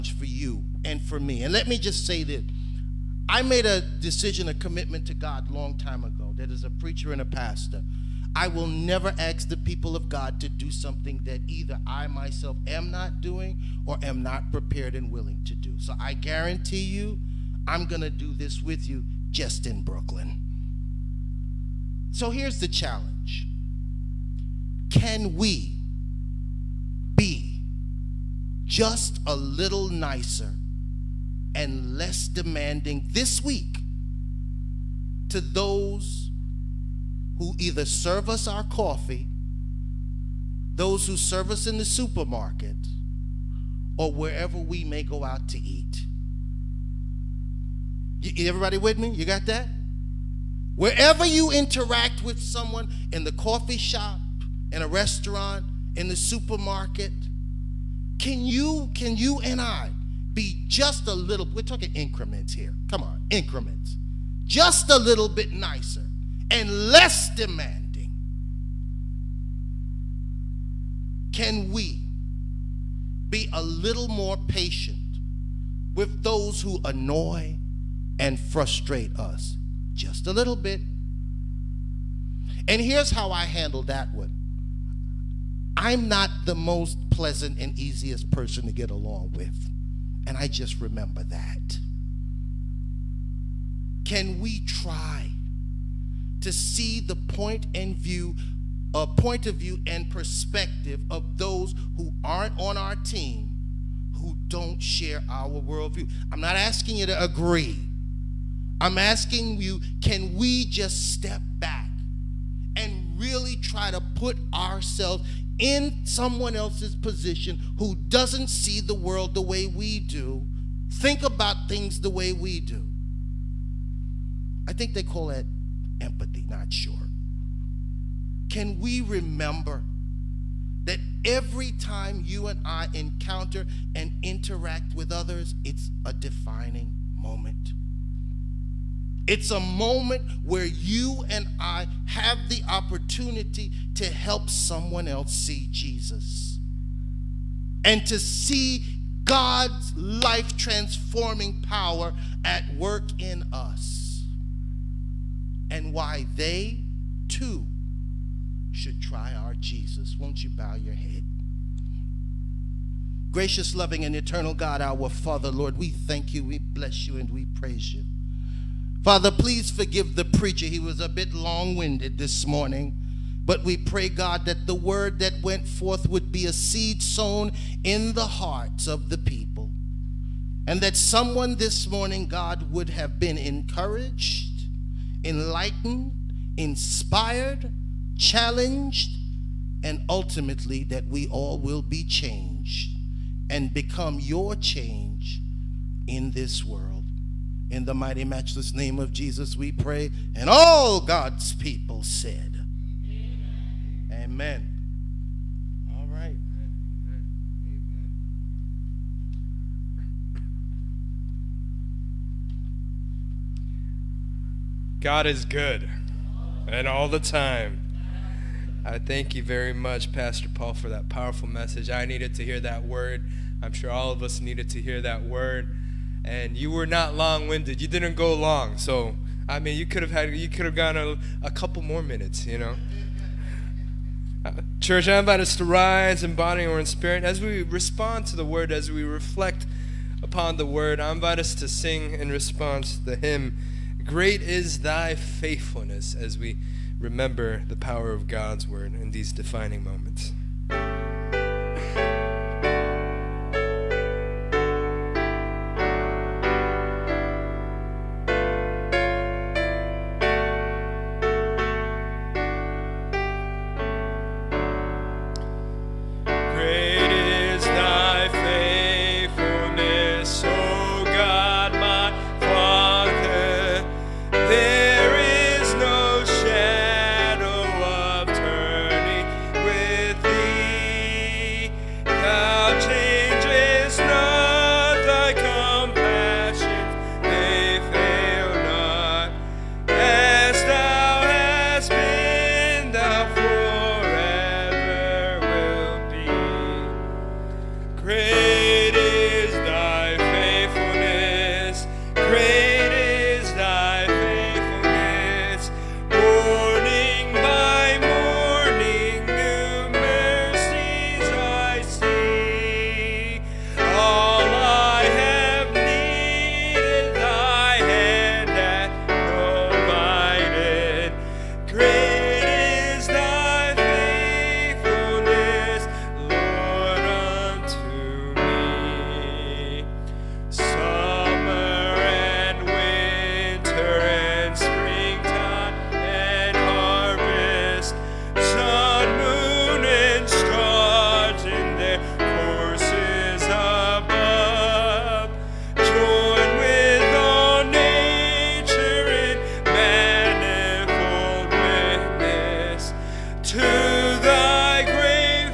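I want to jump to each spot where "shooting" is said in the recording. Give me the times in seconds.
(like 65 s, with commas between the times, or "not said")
not said.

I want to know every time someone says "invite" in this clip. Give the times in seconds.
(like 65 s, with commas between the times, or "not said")
235 s, 241 s.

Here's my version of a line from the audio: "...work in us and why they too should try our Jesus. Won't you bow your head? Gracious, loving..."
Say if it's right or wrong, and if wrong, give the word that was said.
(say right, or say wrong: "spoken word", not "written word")
right.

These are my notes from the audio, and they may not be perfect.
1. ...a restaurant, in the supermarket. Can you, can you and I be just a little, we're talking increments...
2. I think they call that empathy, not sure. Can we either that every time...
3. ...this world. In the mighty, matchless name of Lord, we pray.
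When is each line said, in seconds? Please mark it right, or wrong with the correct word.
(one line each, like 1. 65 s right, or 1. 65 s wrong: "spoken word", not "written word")
1. 54 s right
2. 124 s wrong: "remember", not "either"
3. 196 s wrong: "Jesus", not "Lord".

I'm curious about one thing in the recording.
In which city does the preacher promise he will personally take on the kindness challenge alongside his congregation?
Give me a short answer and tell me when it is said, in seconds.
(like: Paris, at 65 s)
Brooklyn, at 19 s.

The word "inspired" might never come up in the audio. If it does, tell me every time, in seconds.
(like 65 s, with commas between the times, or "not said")
186 s.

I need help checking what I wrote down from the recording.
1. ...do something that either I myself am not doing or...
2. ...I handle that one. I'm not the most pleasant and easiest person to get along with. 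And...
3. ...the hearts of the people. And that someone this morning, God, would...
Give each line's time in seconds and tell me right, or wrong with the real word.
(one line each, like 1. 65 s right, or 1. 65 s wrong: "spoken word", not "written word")
1. 10 s right
2. 83 s right
3. 178 s right.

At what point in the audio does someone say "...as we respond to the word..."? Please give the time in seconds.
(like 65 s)
237 s.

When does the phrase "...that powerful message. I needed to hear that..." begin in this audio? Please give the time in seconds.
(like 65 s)
220 s.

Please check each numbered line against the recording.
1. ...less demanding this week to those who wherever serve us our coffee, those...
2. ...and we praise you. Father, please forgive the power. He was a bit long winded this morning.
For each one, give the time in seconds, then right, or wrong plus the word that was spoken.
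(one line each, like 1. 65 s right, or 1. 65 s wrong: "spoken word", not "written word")
1. 31 s wrong: "either", not "wherever"
2. 167 s wrong: "preacher", not "power".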